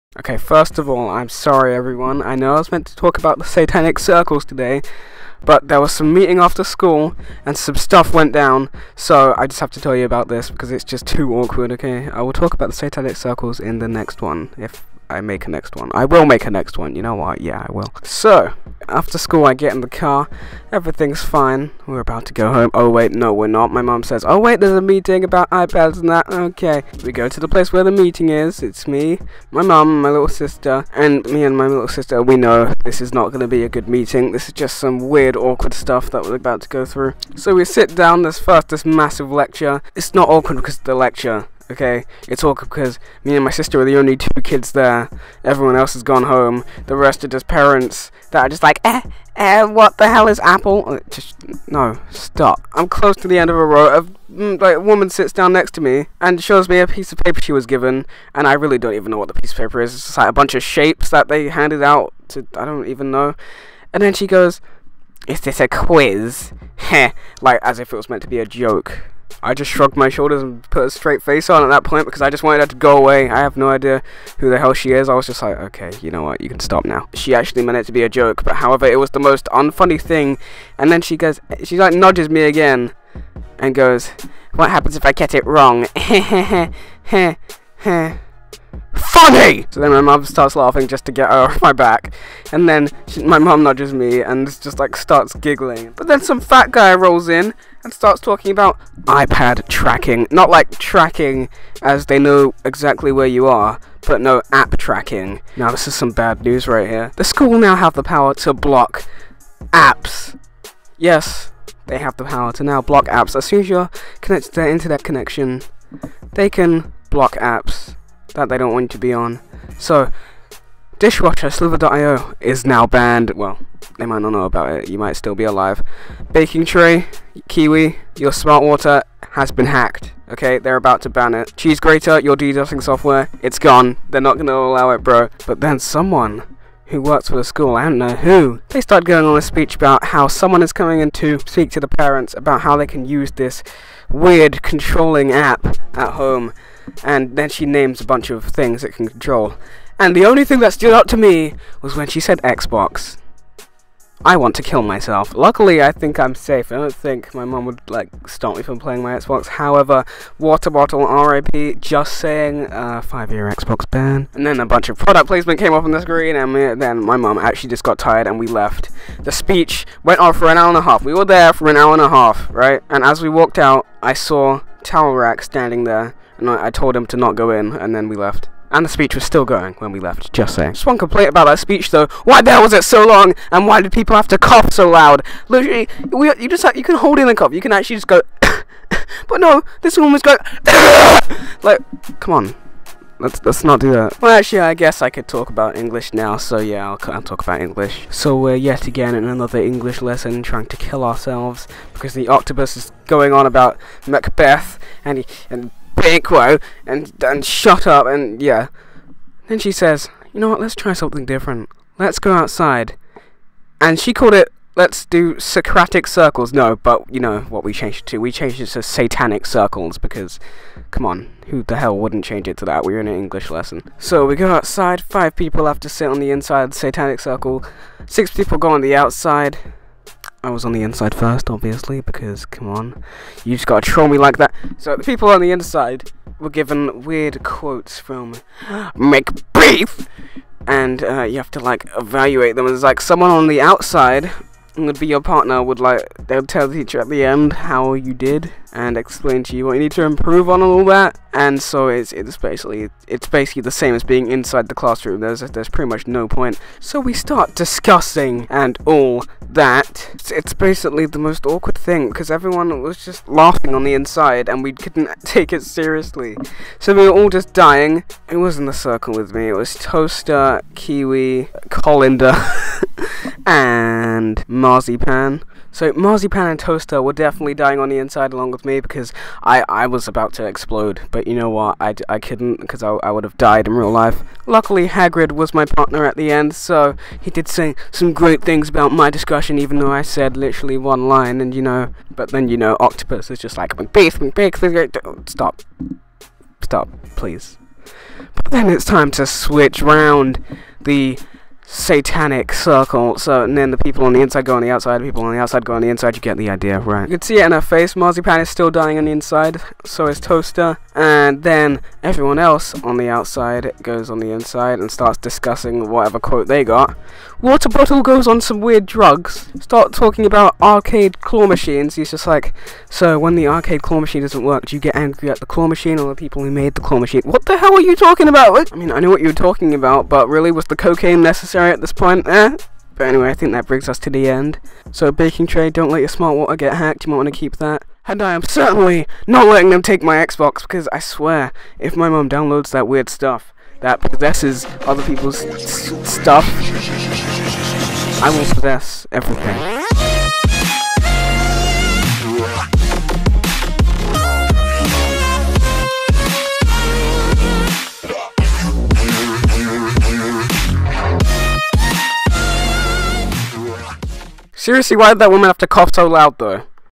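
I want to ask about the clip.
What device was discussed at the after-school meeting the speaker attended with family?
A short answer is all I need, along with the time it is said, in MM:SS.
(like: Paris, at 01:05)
iPads, at 00:25.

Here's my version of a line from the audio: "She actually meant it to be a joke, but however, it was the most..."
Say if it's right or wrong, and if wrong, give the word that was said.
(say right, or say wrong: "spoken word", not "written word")
right.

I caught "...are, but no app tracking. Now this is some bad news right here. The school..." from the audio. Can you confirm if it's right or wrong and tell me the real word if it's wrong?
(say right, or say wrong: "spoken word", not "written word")
right.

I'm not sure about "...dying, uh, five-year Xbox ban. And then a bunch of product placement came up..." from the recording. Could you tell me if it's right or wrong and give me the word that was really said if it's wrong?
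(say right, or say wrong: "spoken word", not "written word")
wrong: "saying", not "dying".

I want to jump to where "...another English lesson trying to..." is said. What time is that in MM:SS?
03:19.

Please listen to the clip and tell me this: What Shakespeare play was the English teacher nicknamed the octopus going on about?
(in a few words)
Macbeth.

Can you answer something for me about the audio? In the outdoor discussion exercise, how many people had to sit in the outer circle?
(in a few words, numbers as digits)
6.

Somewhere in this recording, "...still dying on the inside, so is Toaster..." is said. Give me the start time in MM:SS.
05:08.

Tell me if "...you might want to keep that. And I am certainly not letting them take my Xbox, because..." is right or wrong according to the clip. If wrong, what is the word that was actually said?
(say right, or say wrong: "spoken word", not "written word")
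right.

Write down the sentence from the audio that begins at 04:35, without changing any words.
So marzipan and toaster were definitely dying on the inside along with me because I, I was about to explode.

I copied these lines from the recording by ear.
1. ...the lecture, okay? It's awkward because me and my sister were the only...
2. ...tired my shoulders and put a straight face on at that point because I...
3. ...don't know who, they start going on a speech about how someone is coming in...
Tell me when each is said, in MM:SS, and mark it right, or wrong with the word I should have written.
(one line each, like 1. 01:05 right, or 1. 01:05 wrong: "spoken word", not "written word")
1. 00:40 right
2. 01:09 wrong: "shrugged", not "tired"
3. 02:17 right.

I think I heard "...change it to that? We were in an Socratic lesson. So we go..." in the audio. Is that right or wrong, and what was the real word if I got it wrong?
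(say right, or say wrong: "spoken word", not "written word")
wrong: "English", not "Socratic".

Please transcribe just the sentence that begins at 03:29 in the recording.
Then she says, you know what?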